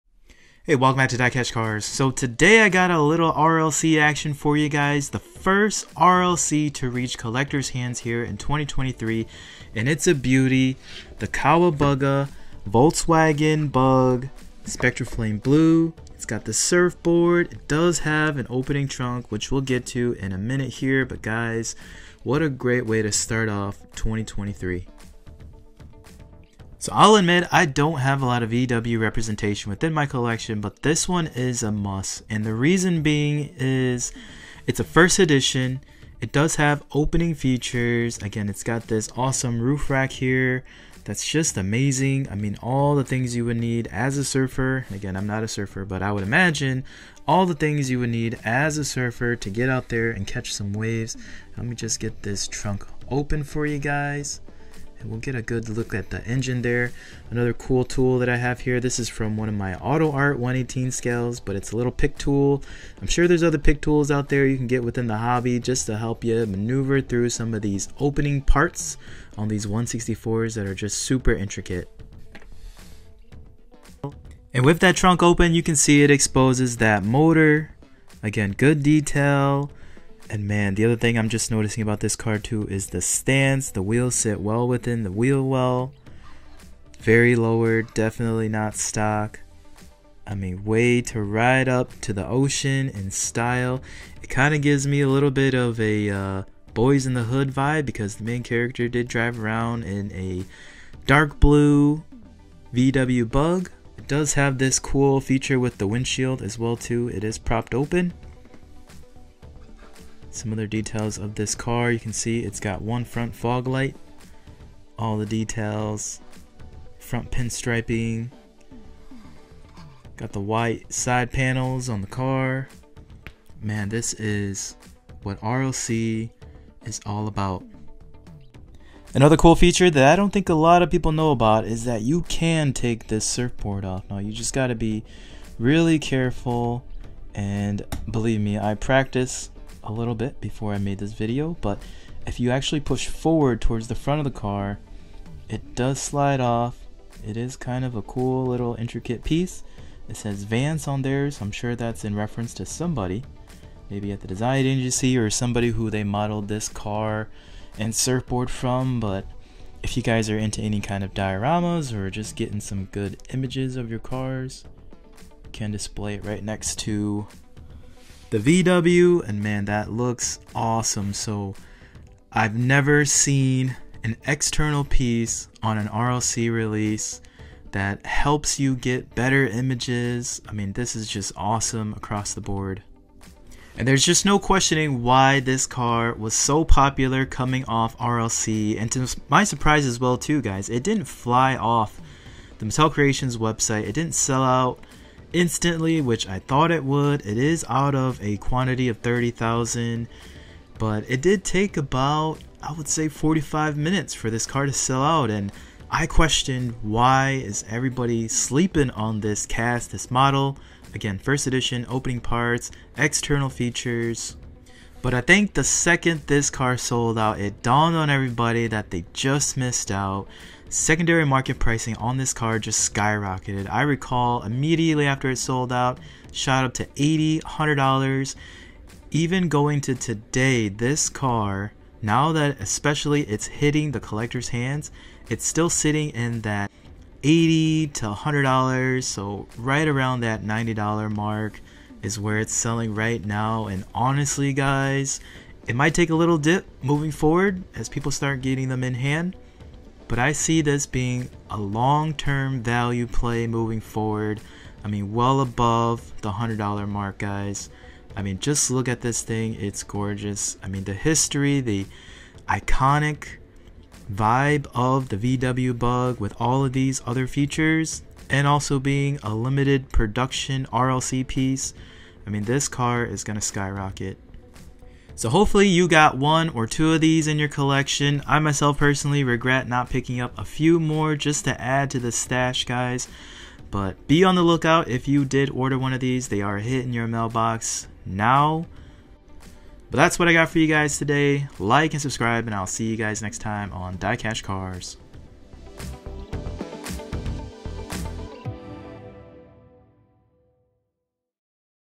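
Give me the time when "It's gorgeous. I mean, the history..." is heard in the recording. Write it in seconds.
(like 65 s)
259 s.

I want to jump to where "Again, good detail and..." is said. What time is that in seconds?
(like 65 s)
78 s.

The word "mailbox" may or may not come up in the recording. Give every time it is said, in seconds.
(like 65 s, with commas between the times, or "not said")
287 s.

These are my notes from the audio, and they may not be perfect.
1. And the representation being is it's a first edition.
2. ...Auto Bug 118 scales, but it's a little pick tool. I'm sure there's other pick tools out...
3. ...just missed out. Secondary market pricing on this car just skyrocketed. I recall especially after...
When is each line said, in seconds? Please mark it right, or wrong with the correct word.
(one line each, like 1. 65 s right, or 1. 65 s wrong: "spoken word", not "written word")
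1. 32 s wrong: "reason", not "representation"
2. 59 s wrong: "Art", not "Bug"
3. 219 s wrong: "immediately", not "especially".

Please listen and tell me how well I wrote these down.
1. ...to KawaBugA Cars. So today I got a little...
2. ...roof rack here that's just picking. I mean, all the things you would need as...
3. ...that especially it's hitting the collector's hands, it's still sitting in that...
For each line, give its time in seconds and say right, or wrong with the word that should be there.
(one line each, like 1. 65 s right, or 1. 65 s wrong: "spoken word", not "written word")
1. 1 s wrong: "DieCash", not "KawaBugA"
2. 39 s wrong: "amazing", not "picking"
3. 232 s right.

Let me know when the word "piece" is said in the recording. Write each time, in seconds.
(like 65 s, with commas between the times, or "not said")
149 s, 174 s, 271 s.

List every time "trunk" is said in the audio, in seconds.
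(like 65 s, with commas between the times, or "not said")
18 s, 52 s, 74 s.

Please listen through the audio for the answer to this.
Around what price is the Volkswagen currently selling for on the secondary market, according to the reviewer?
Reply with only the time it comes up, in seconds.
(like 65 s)
240 s.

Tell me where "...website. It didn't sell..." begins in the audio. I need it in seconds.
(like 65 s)
193 s.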